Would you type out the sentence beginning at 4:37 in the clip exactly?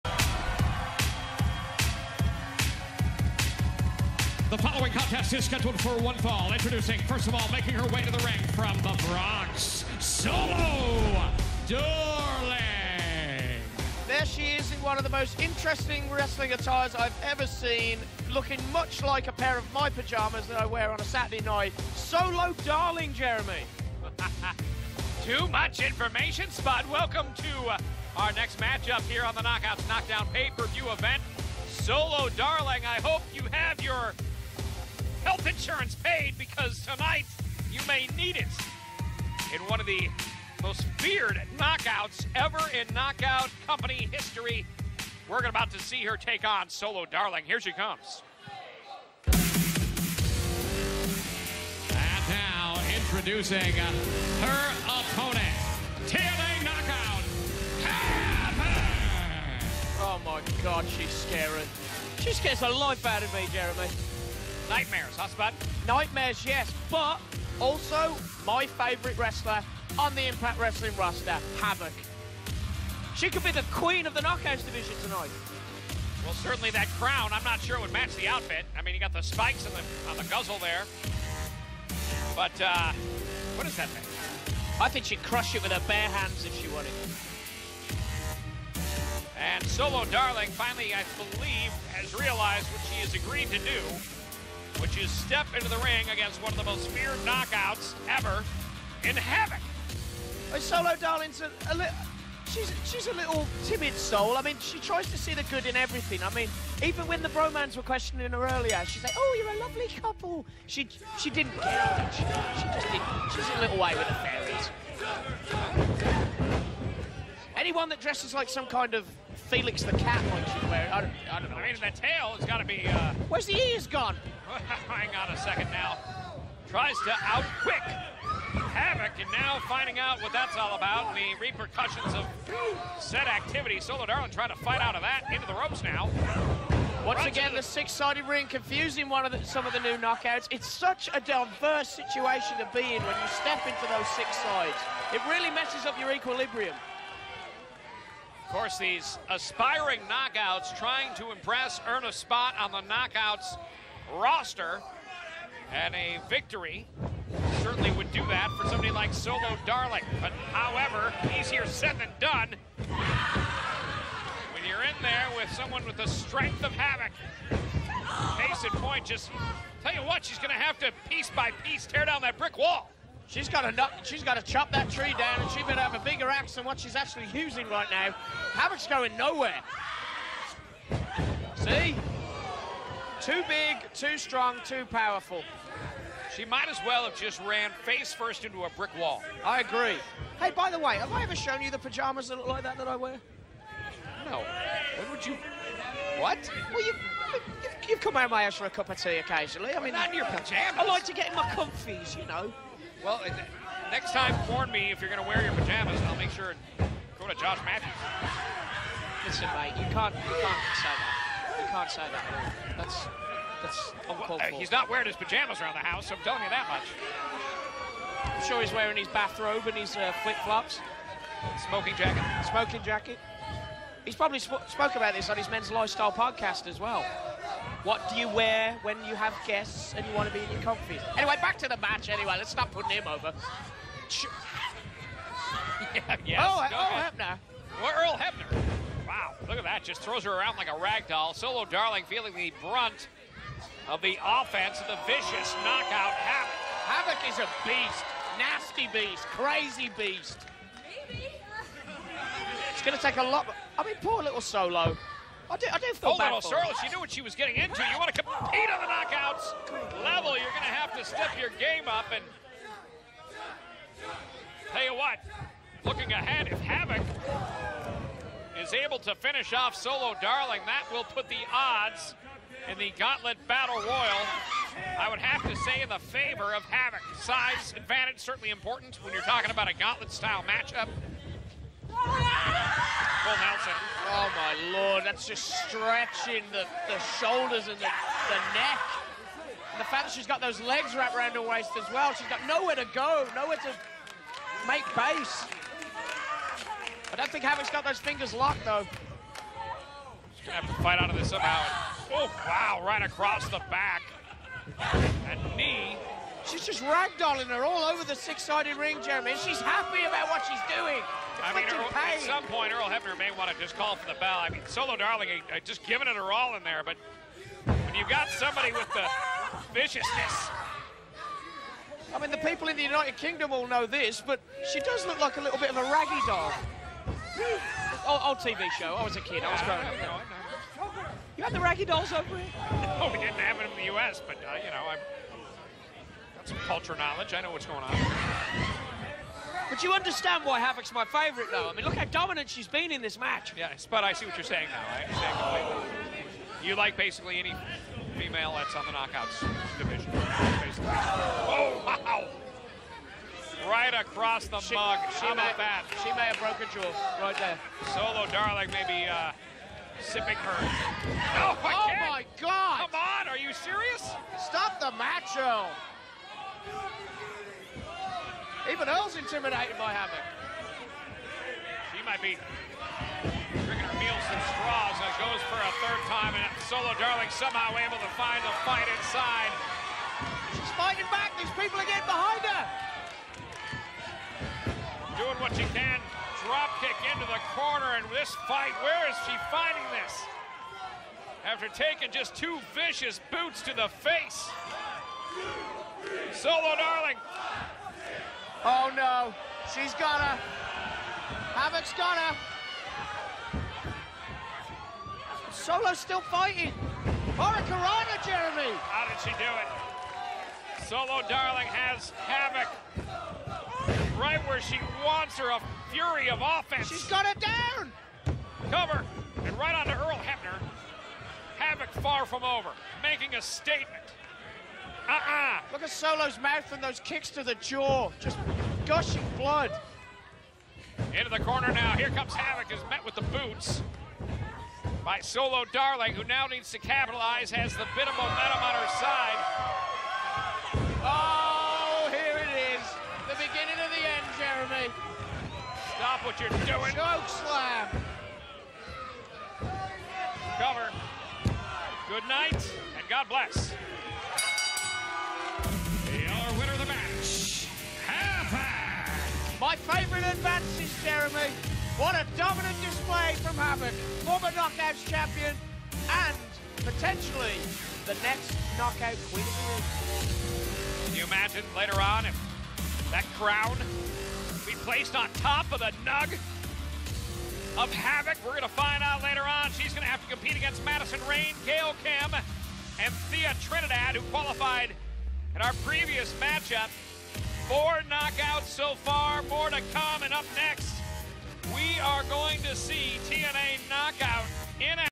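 Size advantage certainly important when you're talking about a Gauntlet-style matchup.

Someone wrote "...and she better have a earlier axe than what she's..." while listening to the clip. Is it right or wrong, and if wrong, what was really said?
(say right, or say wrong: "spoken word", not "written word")
wrong: "bigger", not "earlier".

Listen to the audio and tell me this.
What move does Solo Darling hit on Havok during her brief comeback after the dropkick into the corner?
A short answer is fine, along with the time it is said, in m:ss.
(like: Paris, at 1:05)
Hurricanrana, at 6:47.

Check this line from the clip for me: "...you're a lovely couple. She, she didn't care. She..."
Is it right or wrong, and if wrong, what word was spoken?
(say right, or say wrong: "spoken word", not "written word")
right.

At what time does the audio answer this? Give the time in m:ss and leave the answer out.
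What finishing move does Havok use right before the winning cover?
7:26.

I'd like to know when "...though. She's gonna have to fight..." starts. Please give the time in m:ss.
4:58.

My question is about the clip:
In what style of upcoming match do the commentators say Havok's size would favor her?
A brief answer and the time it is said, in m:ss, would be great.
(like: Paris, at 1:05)
Gauntlet Battle Royal, at 4:32.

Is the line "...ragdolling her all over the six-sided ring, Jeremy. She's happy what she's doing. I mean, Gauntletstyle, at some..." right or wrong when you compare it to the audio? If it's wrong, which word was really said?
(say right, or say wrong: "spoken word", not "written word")
wrong: "Earl", not "Gauntletstyle".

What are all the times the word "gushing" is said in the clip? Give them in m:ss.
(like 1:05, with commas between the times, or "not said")
7:08.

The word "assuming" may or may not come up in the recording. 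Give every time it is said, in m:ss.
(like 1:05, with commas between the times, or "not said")
not said.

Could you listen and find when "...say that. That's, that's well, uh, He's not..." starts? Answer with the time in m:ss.
3:31.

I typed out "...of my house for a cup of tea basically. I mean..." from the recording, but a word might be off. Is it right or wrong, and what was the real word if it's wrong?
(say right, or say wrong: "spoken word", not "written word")
wrong: "occasionally", not "basically".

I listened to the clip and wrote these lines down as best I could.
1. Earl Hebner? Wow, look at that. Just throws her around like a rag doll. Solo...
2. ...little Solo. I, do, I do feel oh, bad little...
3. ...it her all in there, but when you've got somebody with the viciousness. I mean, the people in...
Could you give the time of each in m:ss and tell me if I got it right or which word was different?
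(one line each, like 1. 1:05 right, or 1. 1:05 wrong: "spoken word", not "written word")
1. 3:57 right
2. 4:14 right
3. 5:16 right.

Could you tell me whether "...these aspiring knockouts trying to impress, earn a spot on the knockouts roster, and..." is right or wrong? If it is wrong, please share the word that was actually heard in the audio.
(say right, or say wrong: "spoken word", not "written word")
right.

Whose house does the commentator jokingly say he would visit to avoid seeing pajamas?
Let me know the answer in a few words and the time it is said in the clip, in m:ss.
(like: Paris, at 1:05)
Josh Matthews, at 3:27.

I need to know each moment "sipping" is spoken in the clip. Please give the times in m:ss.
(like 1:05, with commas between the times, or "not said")
6:00.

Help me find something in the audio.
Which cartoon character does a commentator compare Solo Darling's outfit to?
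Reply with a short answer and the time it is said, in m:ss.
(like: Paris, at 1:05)
Felix the Cat, at 1:59.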